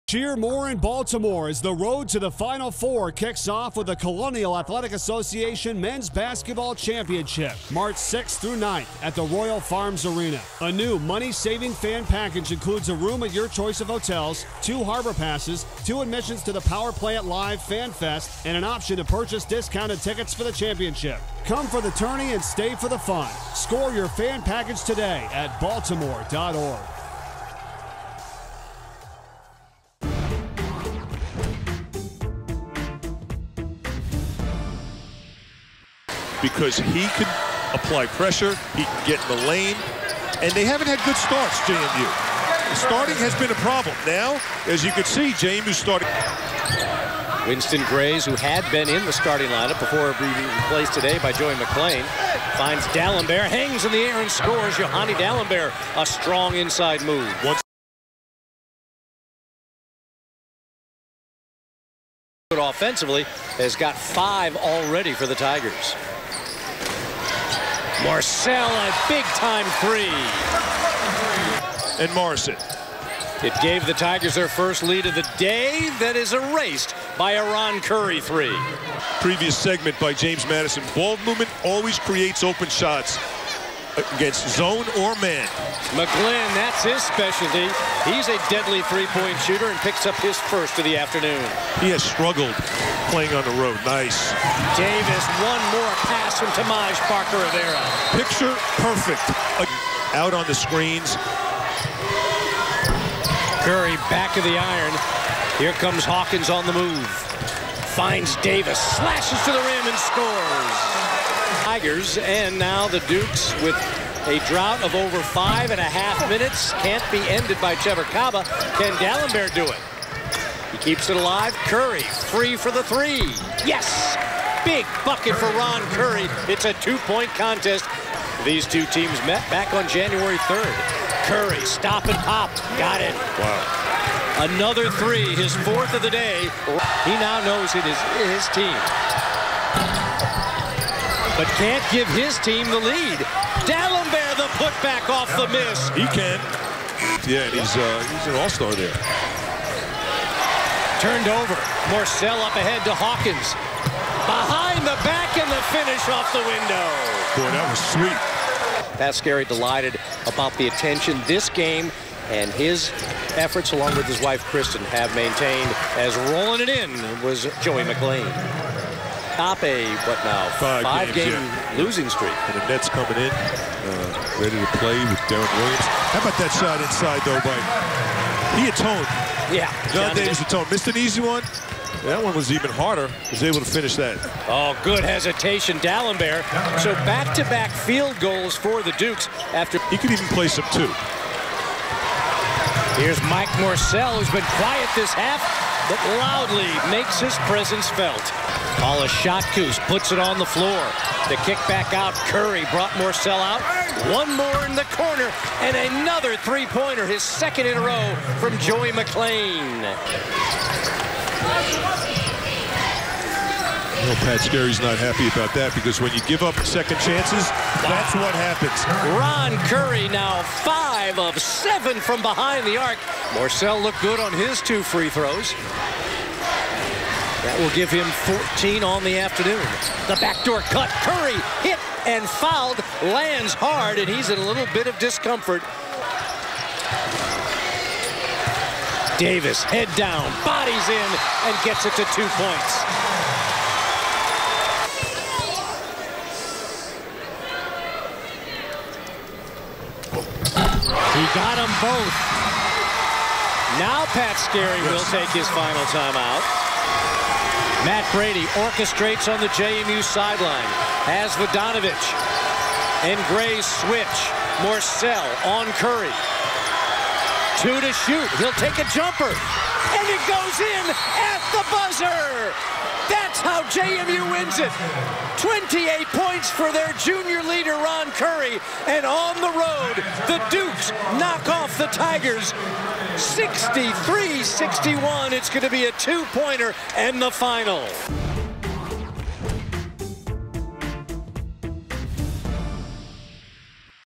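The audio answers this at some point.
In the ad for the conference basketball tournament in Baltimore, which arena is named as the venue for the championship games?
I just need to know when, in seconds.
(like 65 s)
9 s.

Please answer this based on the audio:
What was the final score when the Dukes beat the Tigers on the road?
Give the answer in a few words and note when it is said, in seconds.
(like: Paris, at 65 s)
63-61, at 283 s.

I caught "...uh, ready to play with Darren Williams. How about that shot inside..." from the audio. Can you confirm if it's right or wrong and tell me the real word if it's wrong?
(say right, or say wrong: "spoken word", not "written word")
right.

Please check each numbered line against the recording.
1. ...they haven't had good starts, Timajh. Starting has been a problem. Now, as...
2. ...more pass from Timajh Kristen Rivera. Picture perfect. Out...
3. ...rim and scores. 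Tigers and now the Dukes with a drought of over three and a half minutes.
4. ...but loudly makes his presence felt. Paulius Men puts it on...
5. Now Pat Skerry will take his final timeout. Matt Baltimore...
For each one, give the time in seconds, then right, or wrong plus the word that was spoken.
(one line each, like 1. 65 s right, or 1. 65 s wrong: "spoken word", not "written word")
1. 40 s wrong: "JMU", not "Timajh"
2. 95 s wrong: "Parker", not "Kristen"
3. 109 s wrong: "five", not "three"
4. 195 s wrong: "Satkus", not "Men"
5. 253 s wrong: "Brady", not "Baltimore".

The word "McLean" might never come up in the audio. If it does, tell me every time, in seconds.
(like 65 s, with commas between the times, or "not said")
51 s, 167 s, 208 s.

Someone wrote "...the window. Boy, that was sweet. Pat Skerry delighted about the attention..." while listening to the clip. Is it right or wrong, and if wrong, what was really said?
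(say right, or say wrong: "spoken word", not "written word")
right.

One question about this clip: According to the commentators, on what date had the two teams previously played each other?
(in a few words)
January 3rd.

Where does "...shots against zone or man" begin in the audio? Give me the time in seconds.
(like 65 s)
82 s.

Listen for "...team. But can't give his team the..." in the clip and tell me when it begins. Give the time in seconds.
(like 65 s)
138 s.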